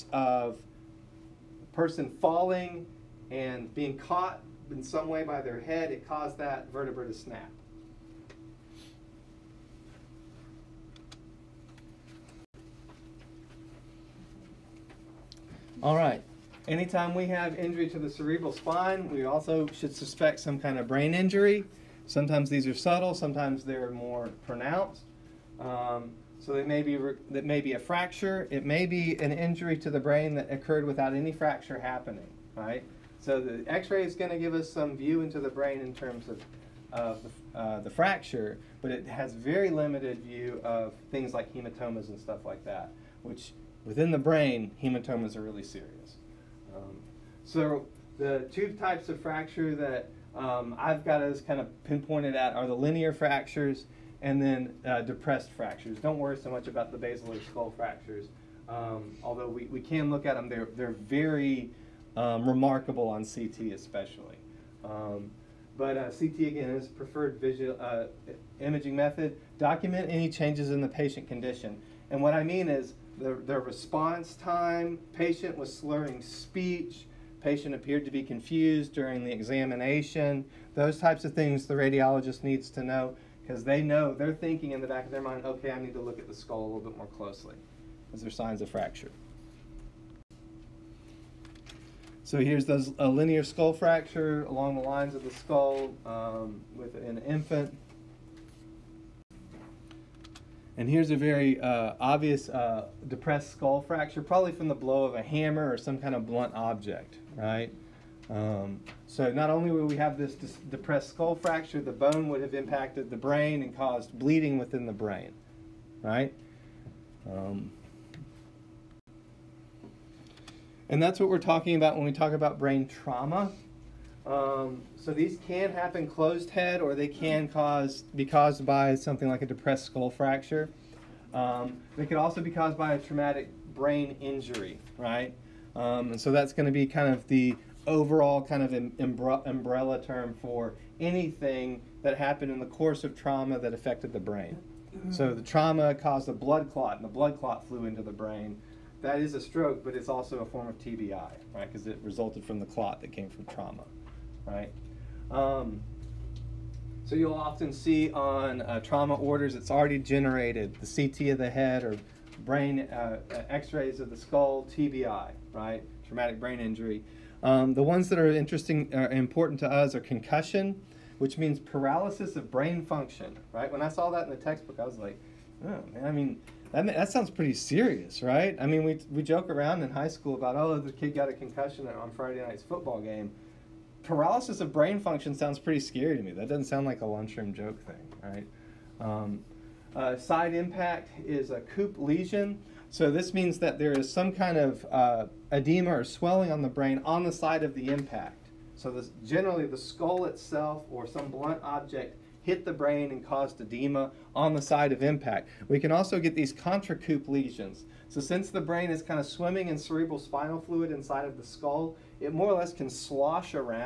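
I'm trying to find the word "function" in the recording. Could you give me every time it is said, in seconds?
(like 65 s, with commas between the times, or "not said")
172 s, 184 s.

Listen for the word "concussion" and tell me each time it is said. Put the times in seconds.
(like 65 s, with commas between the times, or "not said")
169 s, 181 s.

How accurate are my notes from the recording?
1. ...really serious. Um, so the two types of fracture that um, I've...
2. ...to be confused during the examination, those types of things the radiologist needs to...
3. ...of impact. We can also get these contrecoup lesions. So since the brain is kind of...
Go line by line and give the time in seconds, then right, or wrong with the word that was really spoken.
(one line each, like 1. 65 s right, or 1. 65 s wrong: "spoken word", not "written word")
1. 45 s right
2. 78 s right
3. 204 s right.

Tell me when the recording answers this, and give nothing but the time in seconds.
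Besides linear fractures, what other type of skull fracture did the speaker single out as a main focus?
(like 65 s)
55 s.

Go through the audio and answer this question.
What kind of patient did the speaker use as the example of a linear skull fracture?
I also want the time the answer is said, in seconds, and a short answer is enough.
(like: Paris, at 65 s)
An infant, at 96 s.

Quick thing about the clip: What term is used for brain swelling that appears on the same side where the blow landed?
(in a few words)
Coup lesion.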